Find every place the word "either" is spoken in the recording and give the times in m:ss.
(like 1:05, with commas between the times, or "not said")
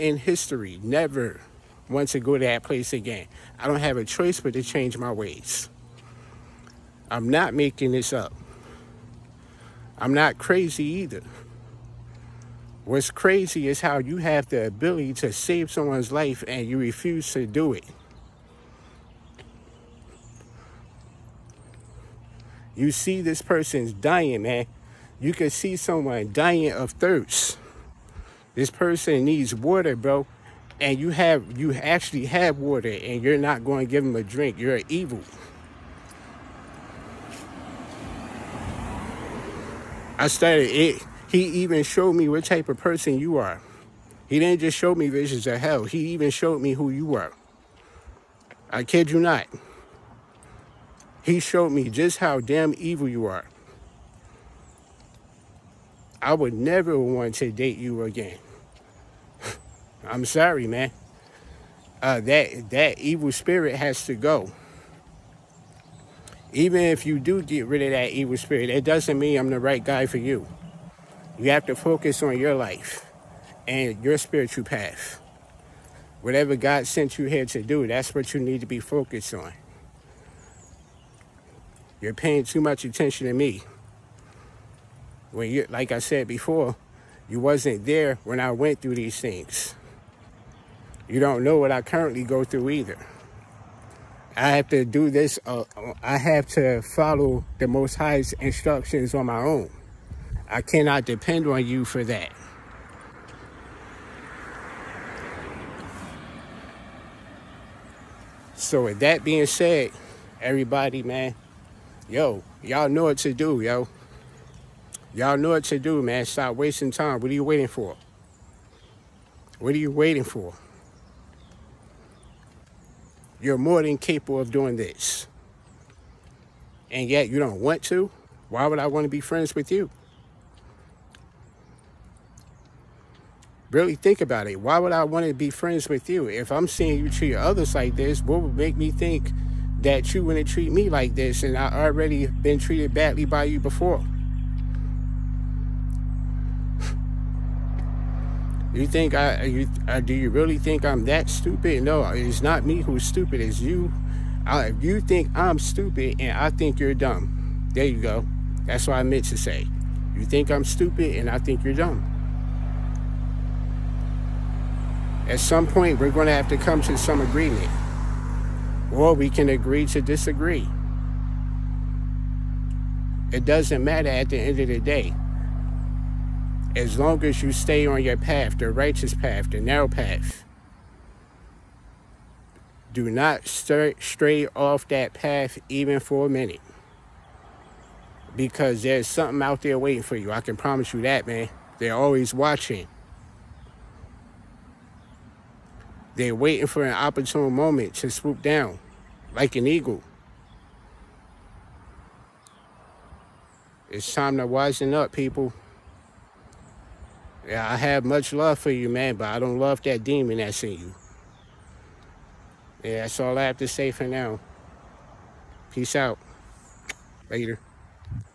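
0:10, 1:32.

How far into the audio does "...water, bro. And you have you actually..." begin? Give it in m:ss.
0:29.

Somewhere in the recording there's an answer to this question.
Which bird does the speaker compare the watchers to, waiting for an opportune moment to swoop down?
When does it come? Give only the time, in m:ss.
3:19.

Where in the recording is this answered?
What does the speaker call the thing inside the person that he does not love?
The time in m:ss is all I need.
3:30.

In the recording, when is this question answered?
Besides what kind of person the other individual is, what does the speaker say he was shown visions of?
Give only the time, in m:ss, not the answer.
0:45.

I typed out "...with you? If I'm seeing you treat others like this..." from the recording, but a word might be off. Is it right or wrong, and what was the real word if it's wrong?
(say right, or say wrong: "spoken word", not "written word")
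right.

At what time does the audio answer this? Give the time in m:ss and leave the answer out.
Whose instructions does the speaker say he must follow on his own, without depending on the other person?
1:37.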